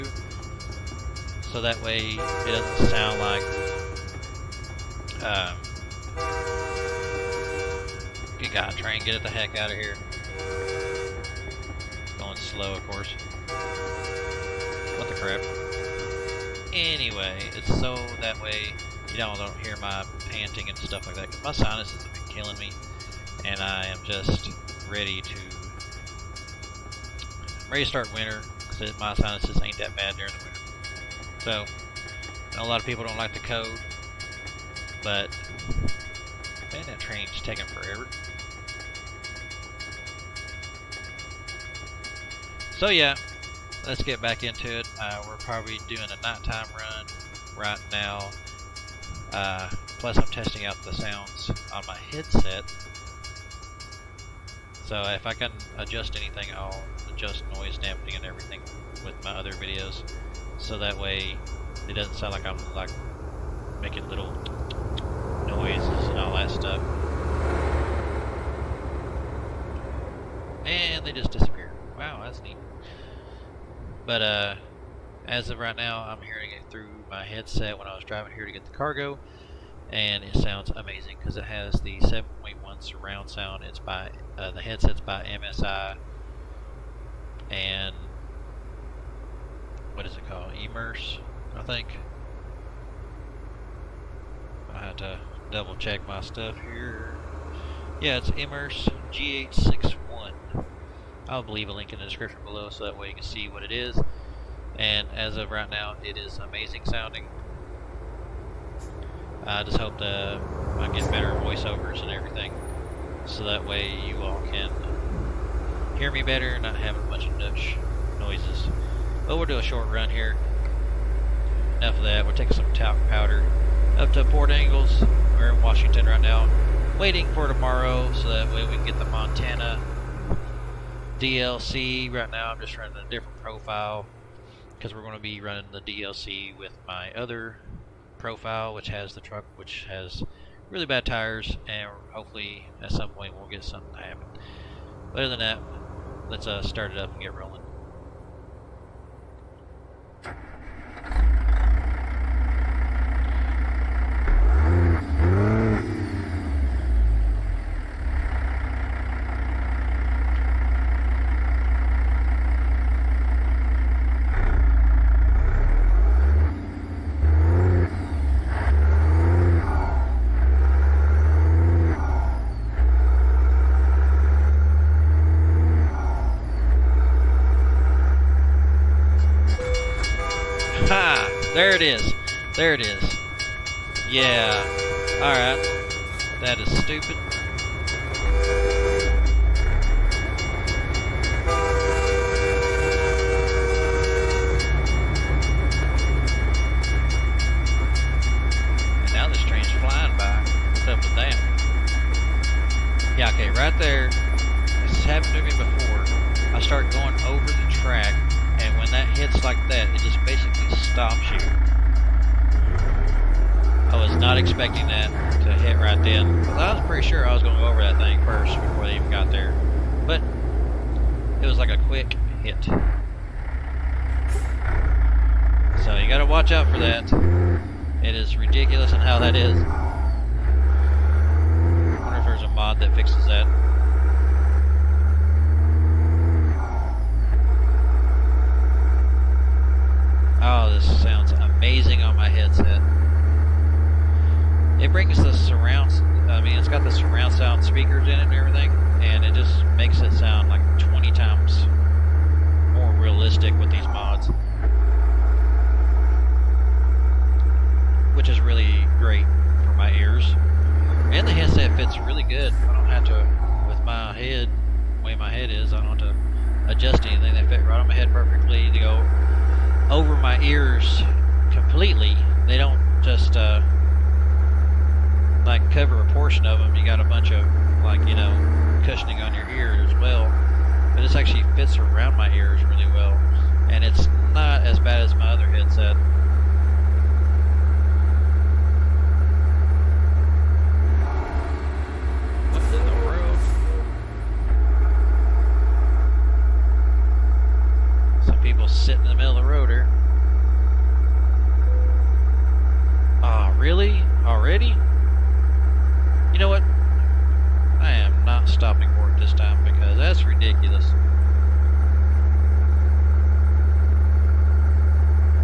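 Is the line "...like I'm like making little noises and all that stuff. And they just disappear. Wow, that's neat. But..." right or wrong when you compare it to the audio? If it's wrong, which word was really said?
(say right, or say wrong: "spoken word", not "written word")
right.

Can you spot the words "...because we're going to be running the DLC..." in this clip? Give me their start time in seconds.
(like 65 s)
134 s.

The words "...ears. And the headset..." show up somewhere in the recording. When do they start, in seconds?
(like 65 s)
259 s.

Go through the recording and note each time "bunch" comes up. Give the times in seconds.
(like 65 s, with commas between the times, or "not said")
117 s, 277 s.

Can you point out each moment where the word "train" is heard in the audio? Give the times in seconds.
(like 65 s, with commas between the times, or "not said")
8 s, 36 s.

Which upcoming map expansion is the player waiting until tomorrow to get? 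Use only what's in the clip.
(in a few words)
Montana DLC.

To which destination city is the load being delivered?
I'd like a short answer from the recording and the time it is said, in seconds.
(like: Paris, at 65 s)
Port Angeles, at 124 s.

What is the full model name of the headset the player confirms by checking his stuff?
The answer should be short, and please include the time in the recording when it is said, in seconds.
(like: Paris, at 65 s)
Immerse GH61, at 98 s.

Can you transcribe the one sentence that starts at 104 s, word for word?
And as of right now, it is amazing sounding.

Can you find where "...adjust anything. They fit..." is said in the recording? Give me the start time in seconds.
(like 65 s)
266 s.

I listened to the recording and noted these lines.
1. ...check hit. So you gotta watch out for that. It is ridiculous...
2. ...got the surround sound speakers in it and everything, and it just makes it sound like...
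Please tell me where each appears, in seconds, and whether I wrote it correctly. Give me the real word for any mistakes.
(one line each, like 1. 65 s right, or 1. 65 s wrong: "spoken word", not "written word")
1. 221 s wrong: "quick", not "check"
2. 246 s right.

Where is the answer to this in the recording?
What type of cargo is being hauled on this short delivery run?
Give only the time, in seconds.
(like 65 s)
122 s.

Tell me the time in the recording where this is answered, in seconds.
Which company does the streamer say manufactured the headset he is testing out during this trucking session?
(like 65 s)
85 s.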